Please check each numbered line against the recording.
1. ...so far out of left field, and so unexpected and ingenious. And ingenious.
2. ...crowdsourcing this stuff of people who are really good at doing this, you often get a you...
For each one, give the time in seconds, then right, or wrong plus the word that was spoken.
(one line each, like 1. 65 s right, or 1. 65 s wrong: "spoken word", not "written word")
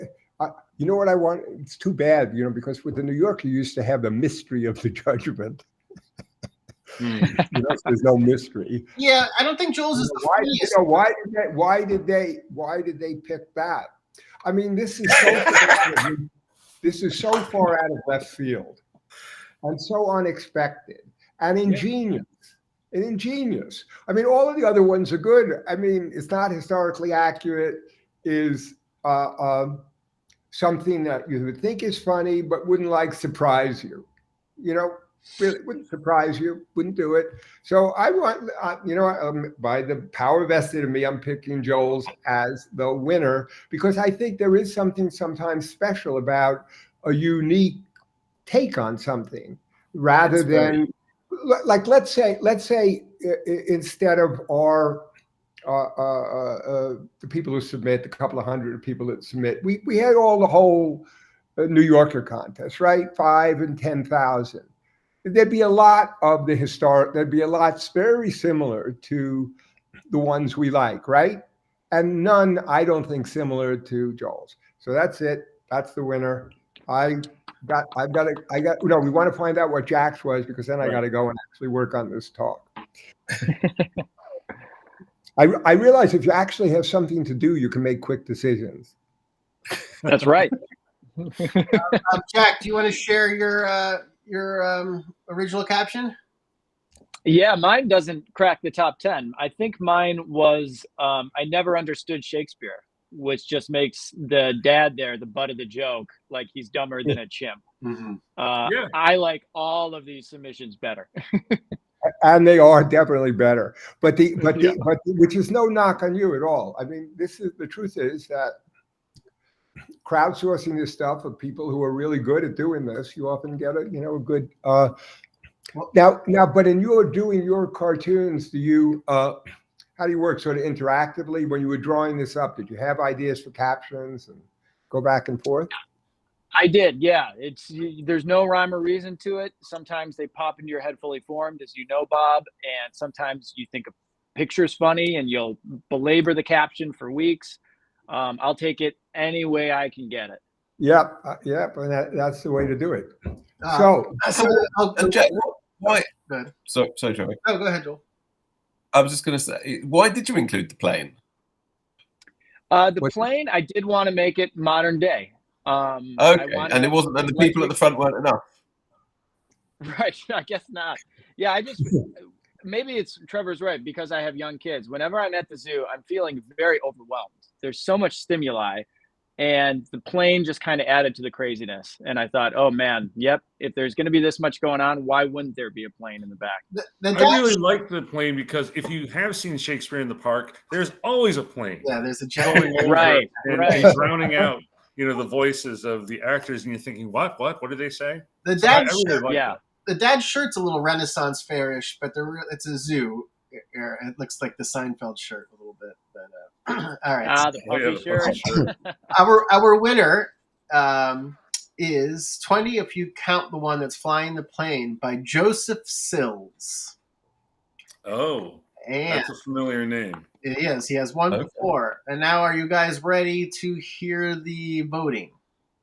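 1. 17 s right
2. 120 s right.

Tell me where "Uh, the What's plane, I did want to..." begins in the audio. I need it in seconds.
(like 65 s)
162 s.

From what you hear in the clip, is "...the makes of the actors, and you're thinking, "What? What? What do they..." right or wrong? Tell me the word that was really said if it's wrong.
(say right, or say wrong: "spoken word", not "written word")
wrong: "voices", not "makes".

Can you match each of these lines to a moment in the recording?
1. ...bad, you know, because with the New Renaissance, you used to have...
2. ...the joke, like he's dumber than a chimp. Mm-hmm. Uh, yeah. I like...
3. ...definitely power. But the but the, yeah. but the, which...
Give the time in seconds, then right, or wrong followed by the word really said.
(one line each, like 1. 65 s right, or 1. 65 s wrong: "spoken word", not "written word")
1. 1 s wrong: "Yorker", not "Renaissance"
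2. 105 s right
3. 112 s wrong: "better", not "power".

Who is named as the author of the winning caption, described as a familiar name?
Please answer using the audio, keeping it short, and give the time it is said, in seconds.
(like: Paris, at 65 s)
Joseph Sills, at 215 s.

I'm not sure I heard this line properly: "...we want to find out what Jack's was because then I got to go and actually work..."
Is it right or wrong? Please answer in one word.
right.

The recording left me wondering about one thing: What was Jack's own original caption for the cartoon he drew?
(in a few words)
I never understood Shakespeare.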